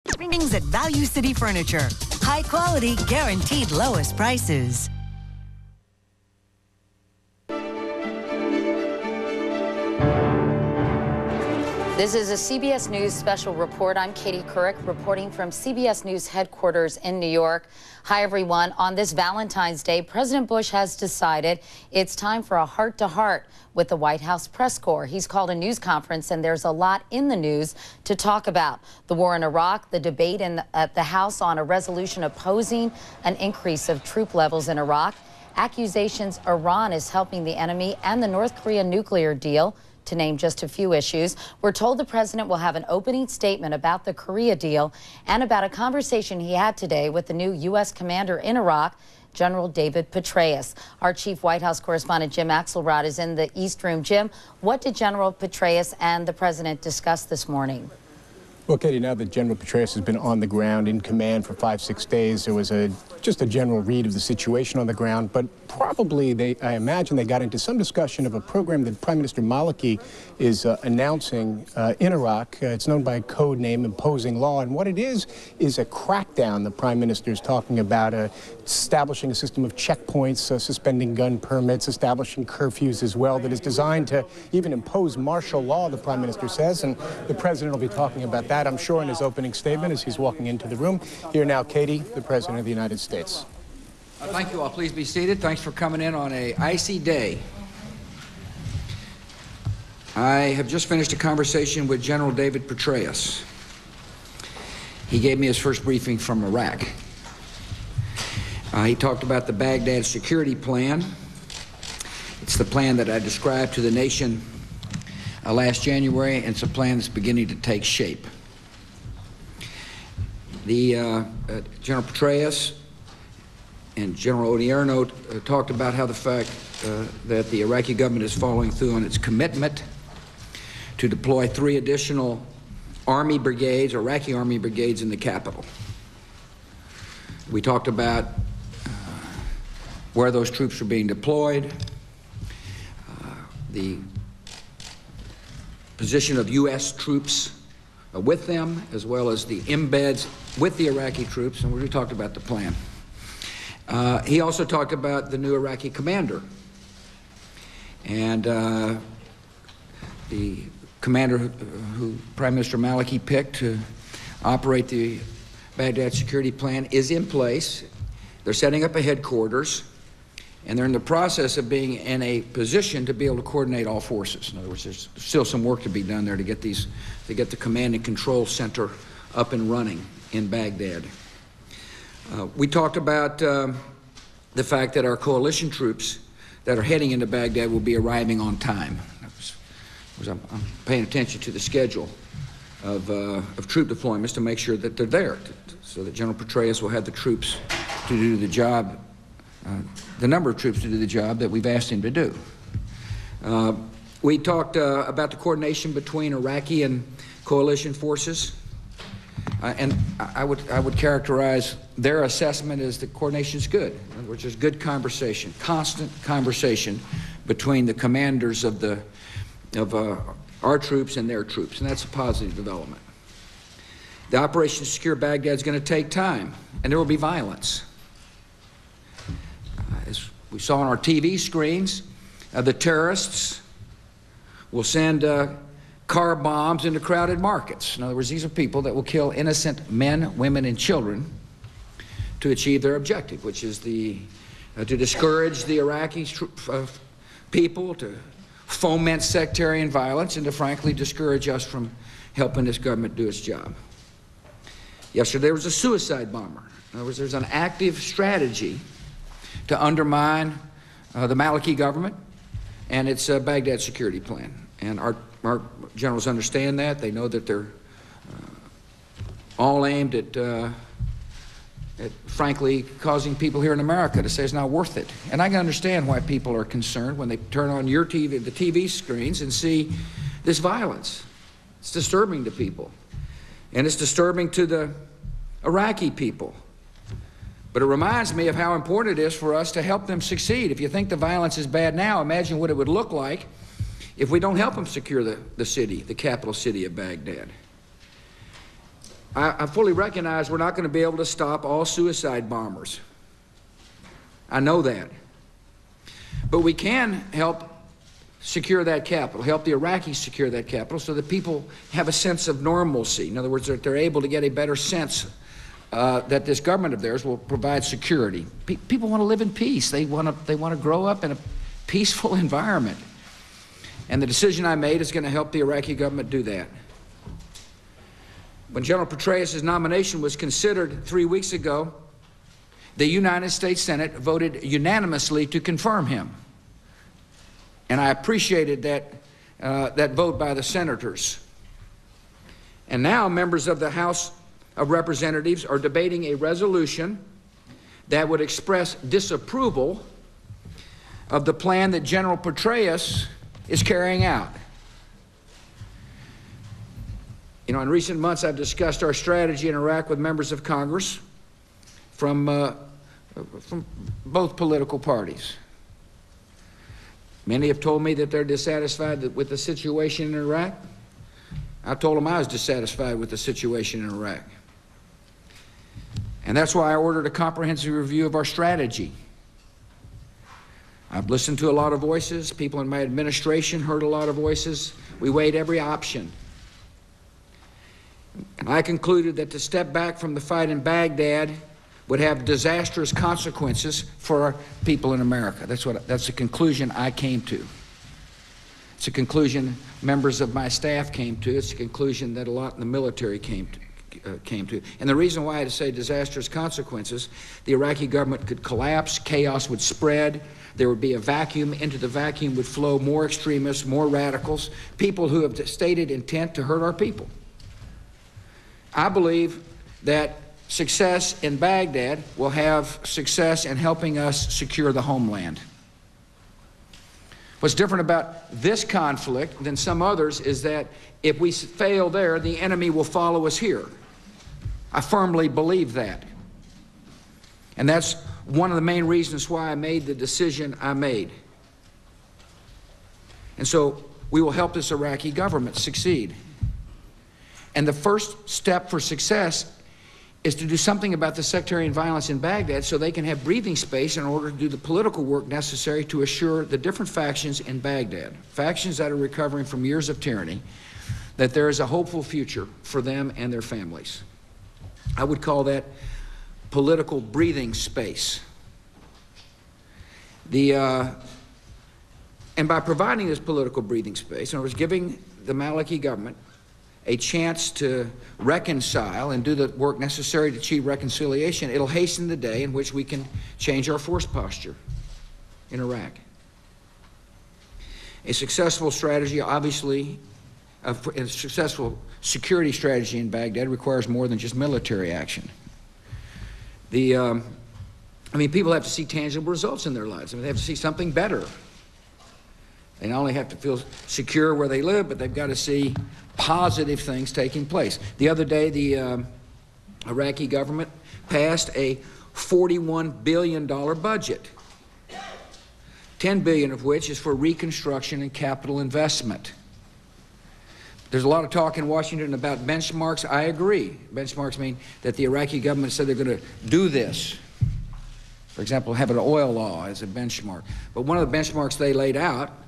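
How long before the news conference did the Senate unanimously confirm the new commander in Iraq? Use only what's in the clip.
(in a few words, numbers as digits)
3 weeks.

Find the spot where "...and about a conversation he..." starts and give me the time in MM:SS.
00:45.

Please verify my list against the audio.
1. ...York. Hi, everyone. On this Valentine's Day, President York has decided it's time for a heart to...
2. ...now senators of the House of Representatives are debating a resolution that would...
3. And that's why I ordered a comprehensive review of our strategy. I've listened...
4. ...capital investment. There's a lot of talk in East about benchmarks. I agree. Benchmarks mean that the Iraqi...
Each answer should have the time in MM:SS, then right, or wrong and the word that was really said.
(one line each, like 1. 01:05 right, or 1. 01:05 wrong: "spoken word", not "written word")
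1. 00:17 wrong: "Bush", not "York"
2. 05:43 wrong: "members", not "senators"
3. 06:16 right
4. 08:38 wrong: "Washington", not "East".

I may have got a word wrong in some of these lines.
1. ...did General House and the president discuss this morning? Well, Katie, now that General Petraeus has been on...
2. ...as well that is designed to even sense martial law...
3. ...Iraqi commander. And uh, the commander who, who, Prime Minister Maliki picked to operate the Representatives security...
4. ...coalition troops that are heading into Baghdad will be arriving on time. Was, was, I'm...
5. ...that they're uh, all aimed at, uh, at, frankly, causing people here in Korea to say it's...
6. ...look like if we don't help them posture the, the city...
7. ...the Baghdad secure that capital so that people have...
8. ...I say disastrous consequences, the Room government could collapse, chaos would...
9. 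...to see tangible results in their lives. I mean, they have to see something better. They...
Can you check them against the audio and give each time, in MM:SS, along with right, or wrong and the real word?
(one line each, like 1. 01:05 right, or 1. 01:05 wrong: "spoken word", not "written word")
1. 00:54 wrong: "Petraeus", not "House"
2. 01:23 wrong: "impose", not "sense"
3. 02:35 wrong: "Baghdad", not "Representatives"
4. 03:05 right
5. 04:27 wrong: "America", not "Korea"
6. 04:52 wrong: "secure", not "posture"
7. 05:09 wrong: "Iraqis", not "Baghdad"
8. 06:45 wrong: "Iraqi", not "Room"
9. 08:18 right.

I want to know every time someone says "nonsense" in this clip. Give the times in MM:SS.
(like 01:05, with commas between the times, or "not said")
not said.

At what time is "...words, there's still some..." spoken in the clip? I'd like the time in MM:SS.
02:54.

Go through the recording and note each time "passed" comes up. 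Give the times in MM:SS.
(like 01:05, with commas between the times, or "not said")
08:31.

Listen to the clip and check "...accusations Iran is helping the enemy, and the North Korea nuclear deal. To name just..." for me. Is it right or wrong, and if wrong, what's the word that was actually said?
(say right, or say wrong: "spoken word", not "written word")
right.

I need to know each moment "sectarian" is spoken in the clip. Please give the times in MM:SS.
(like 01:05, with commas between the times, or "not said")
04:09, 07:31.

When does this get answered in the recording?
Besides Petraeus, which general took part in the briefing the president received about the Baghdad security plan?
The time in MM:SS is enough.
02:04.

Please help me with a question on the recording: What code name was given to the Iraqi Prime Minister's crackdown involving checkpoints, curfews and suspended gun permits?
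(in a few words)
Imposing Law.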